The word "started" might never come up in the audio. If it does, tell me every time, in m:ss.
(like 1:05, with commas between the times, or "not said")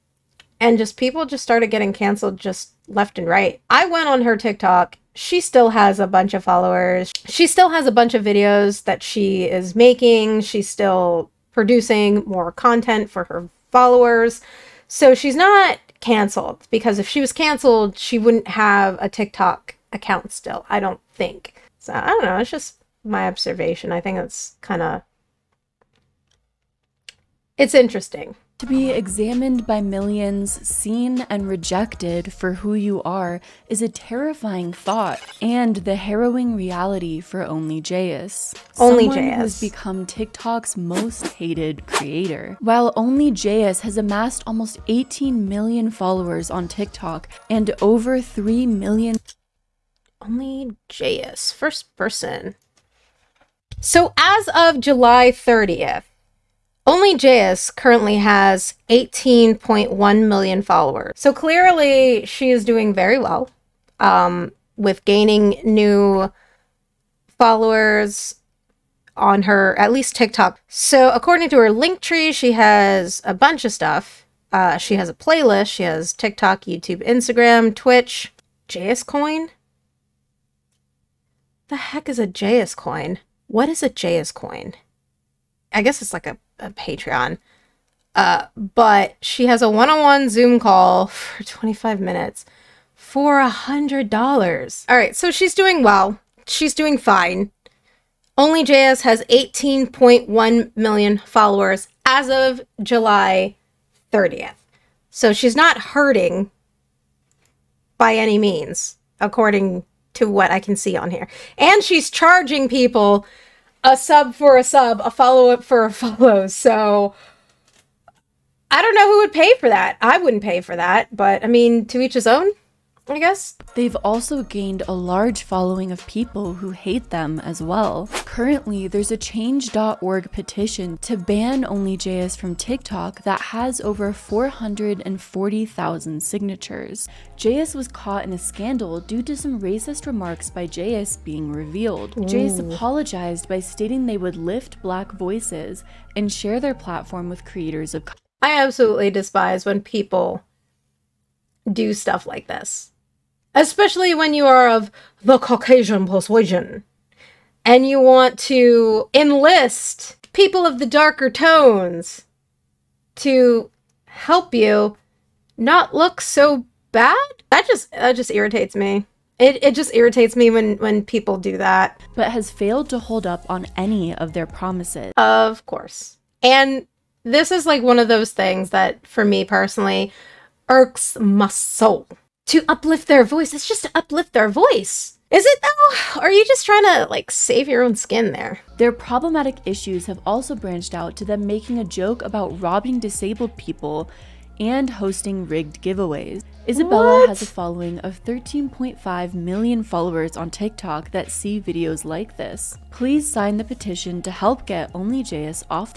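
0:01.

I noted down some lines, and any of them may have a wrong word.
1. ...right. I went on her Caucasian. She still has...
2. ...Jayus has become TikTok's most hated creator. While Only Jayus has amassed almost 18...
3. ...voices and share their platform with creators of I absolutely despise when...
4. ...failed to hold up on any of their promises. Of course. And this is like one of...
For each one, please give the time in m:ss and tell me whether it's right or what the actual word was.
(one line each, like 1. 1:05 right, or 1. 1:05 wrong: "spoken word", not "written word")
1. 0:03 wrong: "TikTok", not "Caucasian"
2. 0:39 right
3. 2:25 right
4. 2:52 right.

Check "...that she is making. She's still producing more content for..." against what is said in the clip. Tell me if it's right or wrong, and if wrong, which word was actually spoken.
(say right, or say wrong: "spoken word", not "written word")
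right.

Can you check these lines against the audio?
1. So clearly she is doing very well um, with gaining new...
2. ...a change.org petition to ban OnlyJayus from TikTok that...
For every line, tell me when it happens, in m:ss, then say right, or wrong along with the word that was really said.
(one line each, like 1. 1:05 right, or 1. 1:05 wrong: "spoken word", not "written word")
1. 1:01 right
2. 2:09 right.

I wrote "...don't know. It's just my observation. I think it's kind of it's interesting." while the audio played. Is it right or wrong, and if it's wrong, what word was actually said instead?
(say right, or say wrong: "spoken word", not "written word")
right.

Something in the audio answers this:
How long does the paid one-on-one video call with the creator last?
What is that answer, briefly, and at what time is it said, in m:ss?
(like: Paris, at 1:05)
25 minutes, at 1:31.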